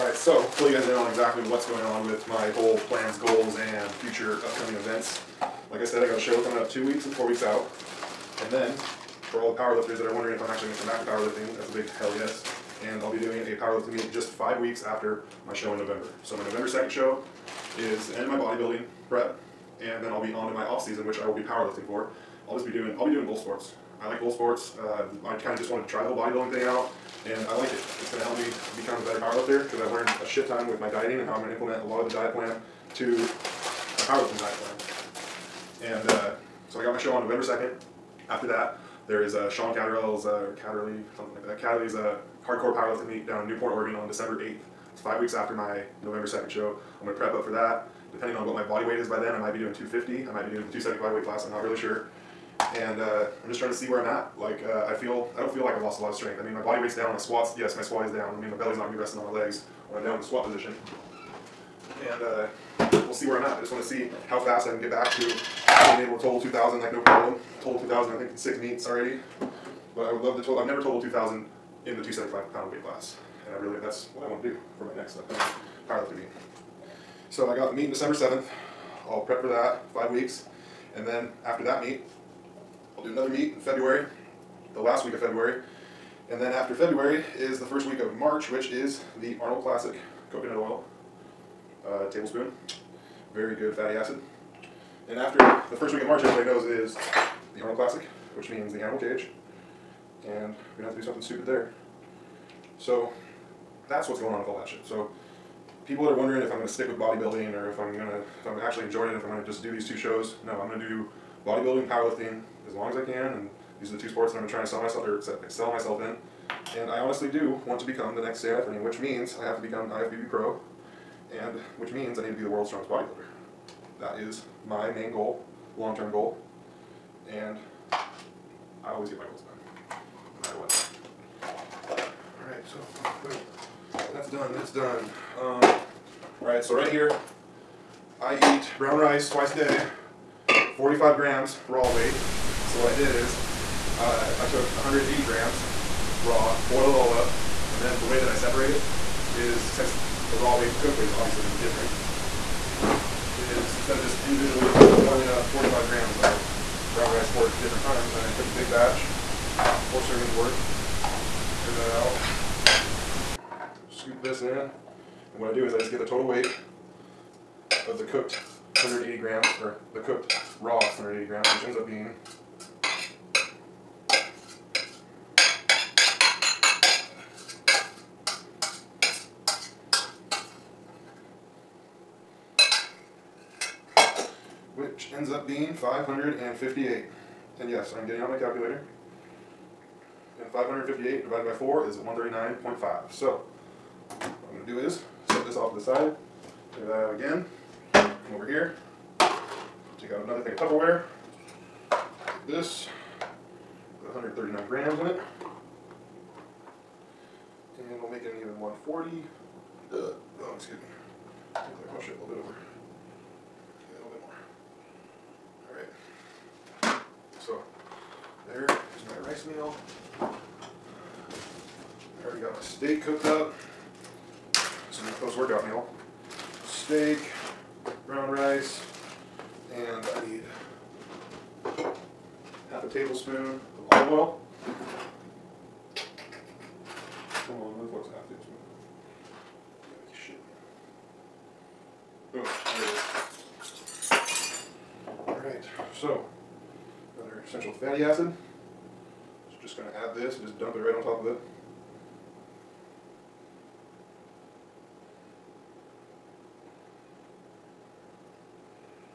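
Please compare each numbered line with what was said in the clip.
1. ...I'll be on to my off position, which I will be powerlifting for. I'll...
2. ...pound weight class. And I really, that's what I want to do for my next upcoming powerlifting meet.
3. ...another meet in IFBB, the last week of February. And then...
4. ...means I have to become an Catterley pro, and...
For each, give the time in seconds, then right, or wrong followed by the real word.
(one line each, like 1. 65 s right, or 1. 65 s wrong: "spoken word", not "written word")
1. 20 s wrong: "season", not "position"
2. 72 s right
3. 83 s wrong: "February", not "IFBB"
4. 118 s wrong: "IFBB", not "Catterley".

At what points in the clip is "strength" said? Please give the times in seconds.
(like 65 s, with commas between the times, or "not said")
56 s.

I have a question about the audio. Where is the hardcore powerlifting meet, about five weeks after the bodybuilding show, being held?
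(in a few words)
Newport, Oregon.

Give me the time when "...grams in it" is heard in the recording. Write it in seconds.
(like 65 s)
204 s.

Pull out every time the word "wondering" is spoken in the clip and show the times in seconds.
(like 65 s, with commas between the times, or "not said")
10 s, 106 s.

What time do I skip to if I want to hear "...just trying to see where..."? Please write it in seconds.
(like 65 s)
53 s.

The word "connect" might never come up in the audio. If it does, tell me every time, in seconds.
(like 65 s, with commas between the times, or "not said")
not said.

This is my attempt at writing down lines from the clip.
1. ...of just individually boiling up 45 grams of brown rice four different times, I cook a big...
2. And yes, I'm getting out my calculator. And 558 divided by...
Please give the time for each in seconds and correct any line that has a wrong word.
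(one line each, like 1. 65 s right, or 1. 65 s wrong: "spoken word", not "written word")
1. 153 s right
2. 187 s right.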